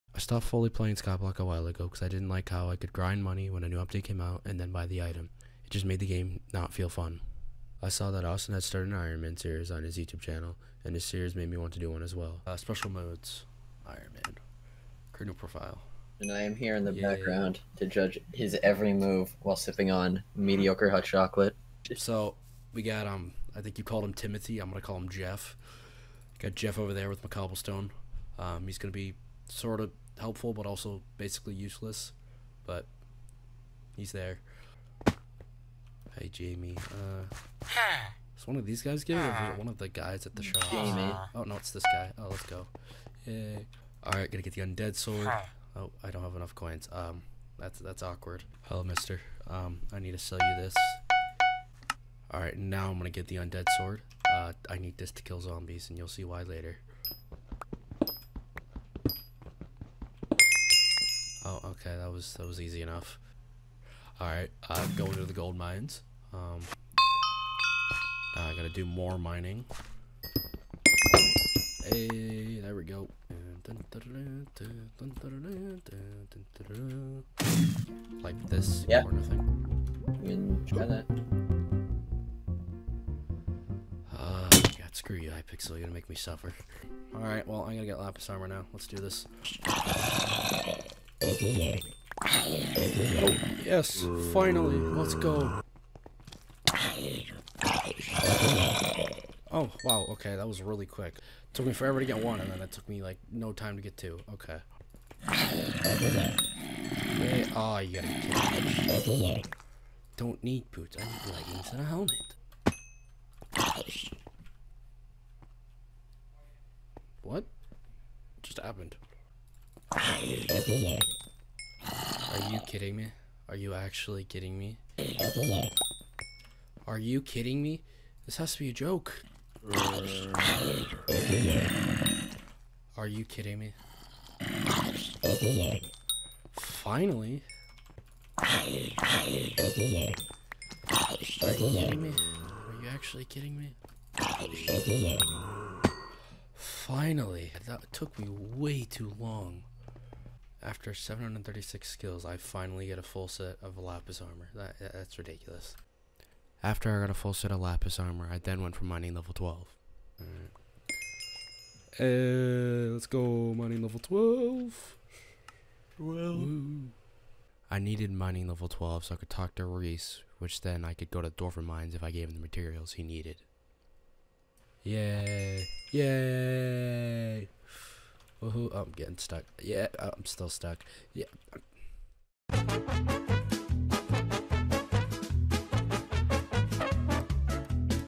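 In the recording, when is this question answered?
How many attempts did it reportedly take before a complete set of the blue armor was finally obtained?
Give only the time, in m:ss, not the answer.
2:30.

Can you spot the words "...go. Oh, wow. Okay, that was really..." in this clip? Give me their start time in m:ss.
1:35.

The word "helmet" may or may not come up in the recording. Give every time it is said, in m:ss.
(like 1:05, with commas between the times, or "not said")
1:51.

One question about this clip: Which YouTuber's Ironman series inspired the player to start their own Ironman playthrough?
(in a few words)
Austin.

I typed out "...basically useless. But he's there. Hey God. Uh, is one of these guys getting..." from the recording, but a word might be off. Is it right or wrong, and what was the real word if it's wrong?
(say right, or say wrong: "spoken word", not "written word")
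wrong: "Jamie", not "God".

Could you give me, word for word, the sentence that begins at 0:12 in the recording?
Uh, special modes, Ironman, create profile.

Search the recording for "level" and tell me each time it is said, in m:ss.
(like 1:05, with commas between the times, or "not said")
2:39, 2:43, 2:48.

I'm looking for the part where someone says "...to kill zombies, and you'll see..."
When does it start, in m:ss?
0:55.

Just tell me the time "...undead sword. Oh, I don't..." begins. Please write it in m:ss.
0:44.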